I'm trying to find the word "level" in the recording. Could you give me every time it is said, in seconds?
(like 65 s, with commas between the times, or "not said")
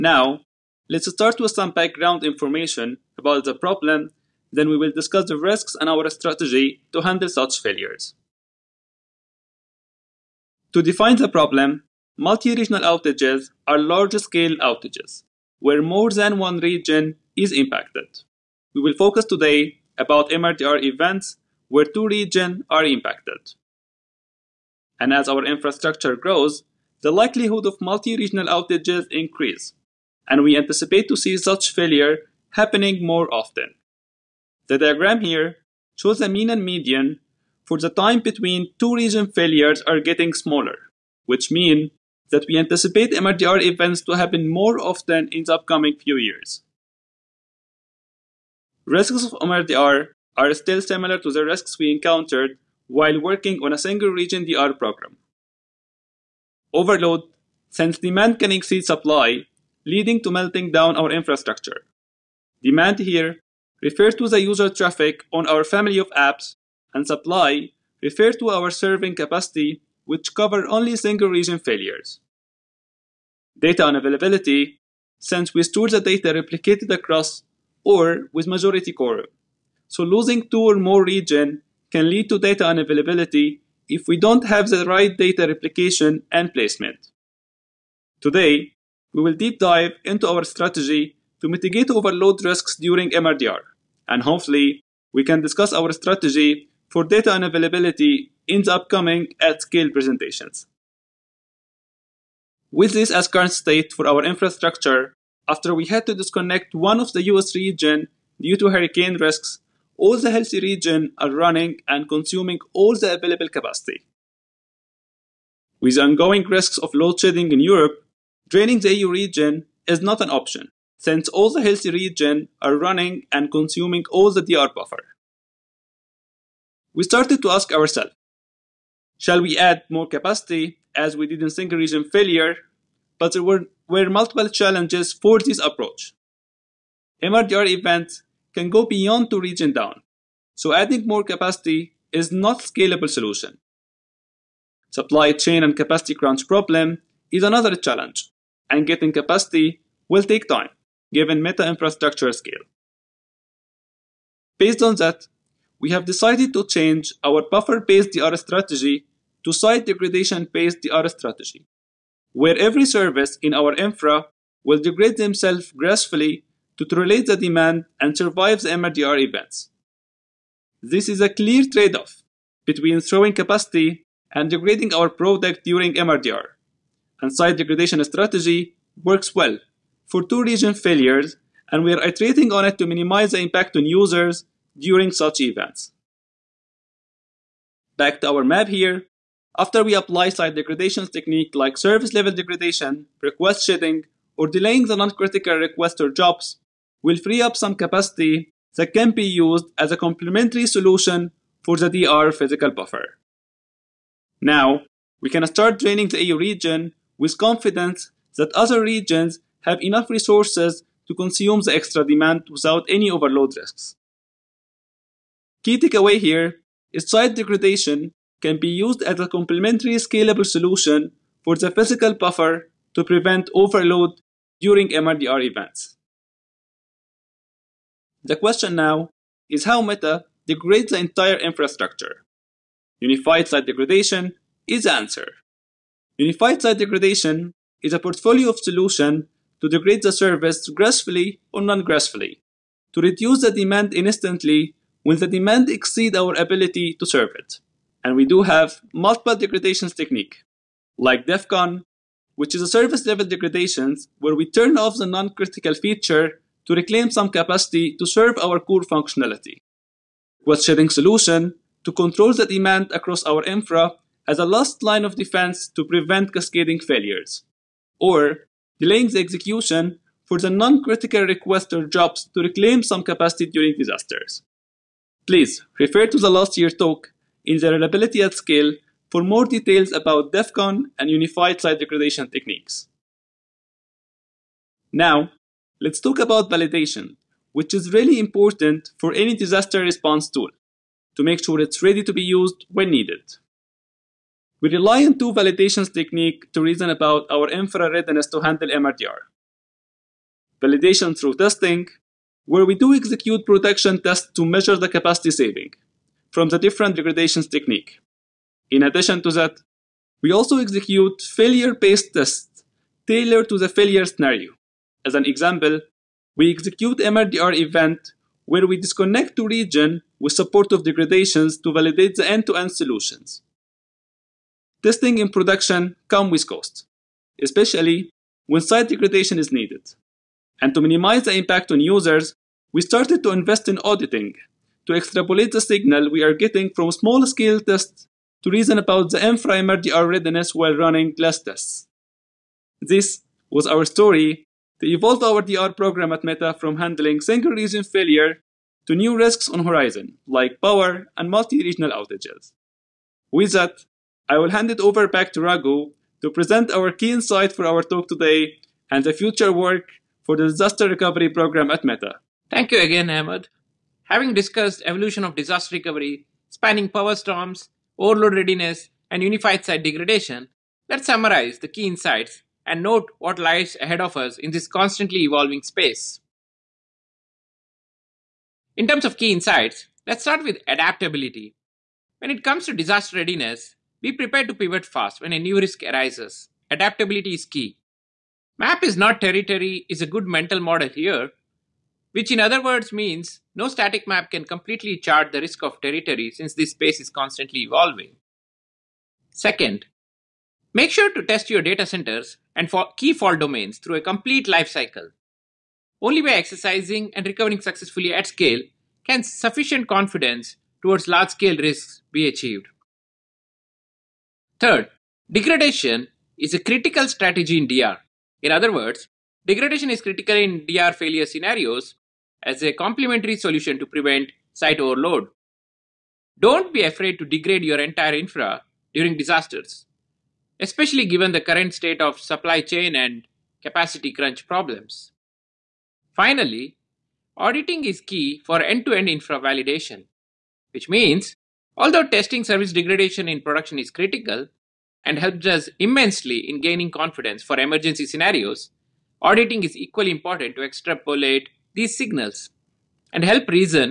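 192 s, 253 s.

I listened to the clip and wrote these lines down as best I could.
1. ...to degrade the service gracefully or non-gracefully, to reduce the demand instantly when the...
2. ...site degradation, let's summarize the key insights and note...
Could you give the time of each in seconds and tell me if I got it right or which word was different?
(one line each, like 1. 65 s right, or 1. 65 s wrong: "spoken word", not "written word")
1. 239 s right
2. 369 s right.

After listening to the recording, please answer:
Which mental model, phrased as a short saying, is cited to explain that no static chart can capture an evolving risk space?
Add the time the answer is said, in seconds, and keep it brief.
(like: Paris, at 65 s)
Map is not territory, at 388 s.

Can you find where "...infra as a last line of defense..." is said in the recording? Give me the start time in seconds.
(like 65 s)
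263 s.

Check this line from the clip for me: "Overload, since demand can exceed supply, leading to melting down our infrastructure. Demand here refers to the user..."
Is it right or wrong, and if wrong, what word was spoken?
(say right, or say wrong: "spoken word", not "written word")
right.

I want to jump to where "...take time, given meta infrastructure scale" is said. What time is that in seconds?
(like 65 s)
150 s.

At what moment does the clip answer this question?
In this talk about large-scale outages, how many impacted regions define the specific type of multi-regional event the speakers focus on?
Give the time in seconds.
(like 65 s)
21 s.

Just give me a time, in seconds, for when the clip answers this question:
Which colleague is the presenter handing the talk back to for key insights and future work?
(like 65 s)
355 s.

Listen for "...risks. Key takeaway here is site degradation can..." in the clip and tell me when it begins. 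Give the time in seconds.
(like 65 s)
213 s.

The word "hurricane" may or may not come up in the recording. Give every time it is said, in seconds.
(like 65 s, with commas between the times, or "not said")
108 s.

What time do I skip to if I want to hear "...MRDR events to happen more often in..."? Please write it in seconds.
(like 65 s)
43 s.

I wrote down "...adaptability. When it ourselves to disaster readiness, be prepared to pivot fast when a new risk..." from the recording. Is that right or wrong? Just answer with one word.
wrong.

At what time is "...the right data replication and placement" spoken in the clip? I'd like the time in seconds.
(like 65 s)
84 s.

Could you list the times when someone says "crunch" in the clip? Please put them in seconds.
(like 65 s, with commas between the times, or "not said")
146 s, 434 s.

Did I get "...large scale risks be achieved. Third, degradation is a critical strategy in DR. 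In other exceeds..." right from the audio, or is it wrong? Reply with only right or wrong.
wrong.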